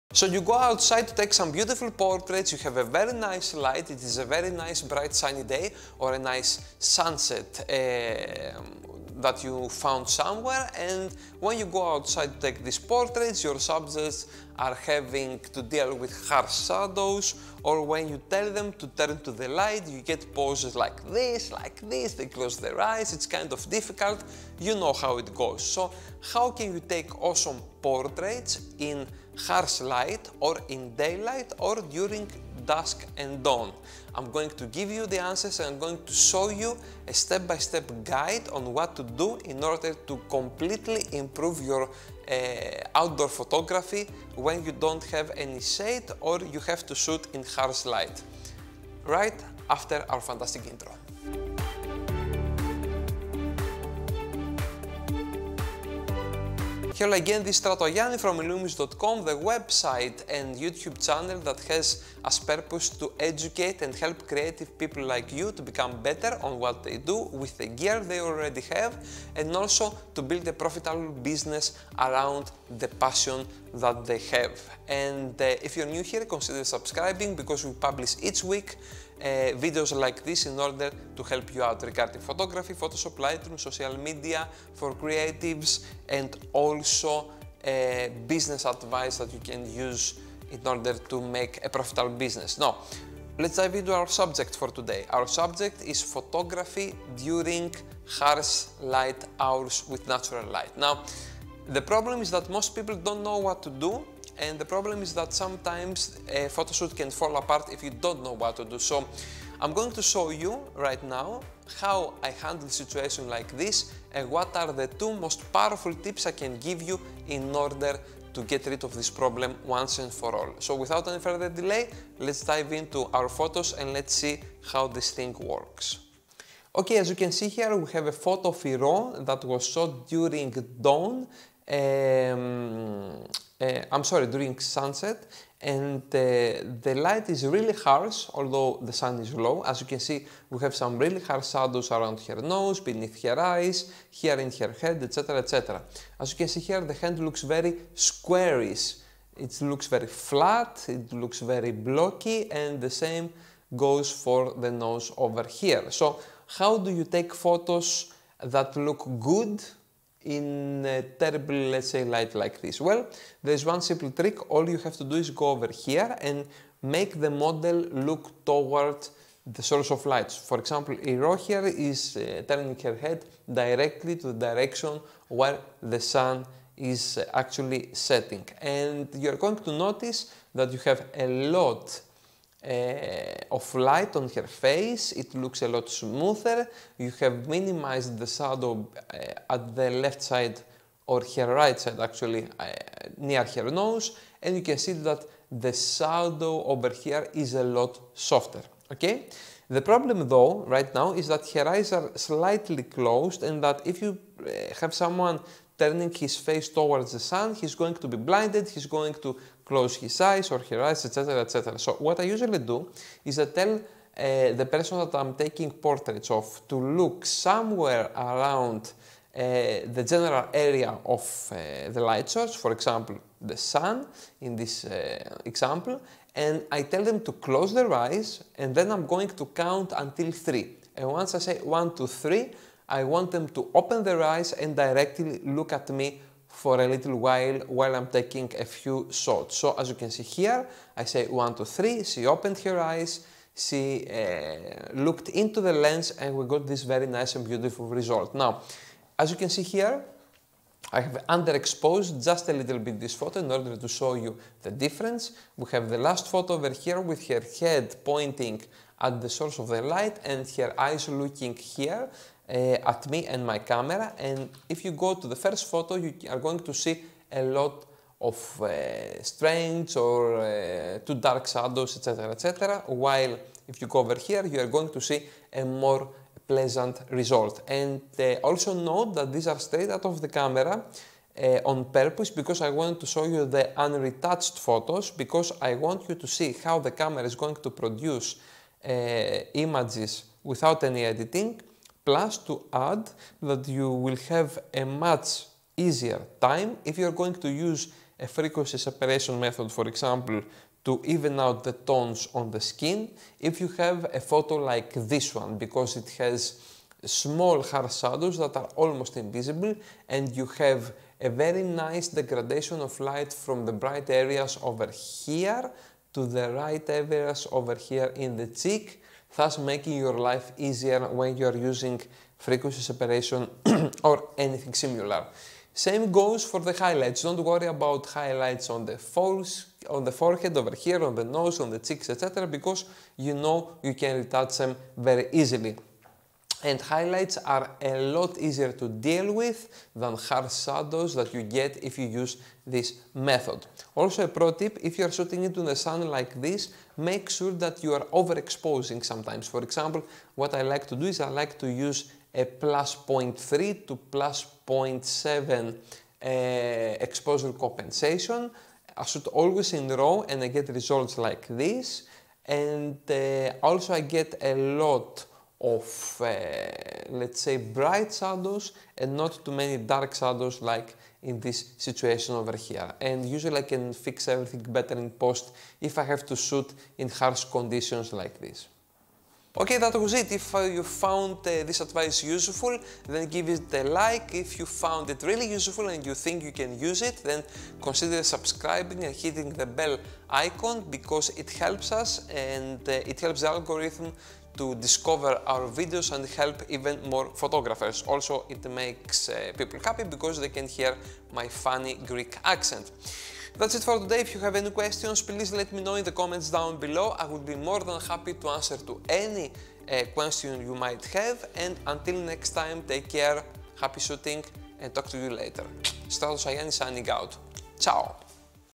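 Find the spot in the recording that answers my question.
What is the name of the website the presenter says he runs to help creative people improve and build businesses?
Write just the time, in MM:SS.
00:58.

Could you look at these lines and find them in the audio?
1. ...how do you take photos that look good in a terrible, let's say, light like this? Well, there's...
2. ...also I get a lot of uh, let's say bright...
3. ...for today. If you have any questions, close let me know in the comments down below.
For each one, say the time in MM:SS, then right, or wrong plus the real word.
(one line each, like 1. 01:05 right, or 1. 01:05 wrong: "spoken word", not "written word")
1. 02:36 right
2. 06:03 right
3. 06:43 wrong: "please", not "close".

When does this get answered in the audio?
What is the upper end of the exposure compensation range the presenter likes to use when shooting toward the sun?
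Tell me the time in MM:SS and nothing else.
05:53.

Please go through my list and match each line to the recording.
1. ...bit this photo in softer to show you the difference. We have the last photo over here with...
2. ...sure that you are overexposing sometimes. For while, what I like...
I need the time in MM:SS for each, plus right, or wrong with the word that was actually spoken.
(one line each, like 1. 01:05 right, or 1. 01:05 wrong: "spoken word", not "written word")
1. 04:12 wrong: "order", not "softer"
2. 05:47 wrong: "example", not "while".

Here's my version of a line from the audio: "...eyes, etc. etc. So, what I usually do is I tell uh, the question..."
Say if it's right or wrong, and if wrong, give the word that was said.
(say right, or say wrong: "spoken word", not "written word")
wrong: "person", not "question".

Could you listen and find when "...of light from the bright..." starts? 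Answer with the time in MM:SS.
05:12.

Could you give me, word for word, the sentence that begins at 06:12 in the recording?
And usually I can fix everything better in post if I have to shoot in harsh conditions like this.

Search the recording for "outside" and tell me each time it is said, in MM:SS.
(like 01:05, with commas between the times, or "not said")
00:00, 00:11.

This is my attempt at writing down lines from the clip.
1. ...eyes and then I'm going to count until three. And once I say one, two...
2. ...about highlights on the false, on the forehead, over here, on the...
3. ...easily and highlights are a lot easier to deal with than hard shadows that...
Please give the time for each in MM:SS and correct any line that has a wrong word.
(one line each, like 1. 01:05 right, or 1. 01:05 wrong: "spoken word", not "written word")
1. 03:47 right
2. 05:27 right
3. 05:35 right.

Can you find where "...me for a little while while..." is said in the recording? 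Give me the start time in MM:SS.
03:55.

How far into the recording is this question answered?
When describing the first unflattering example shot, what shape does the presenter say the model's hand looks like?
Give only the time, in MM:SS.
02:27.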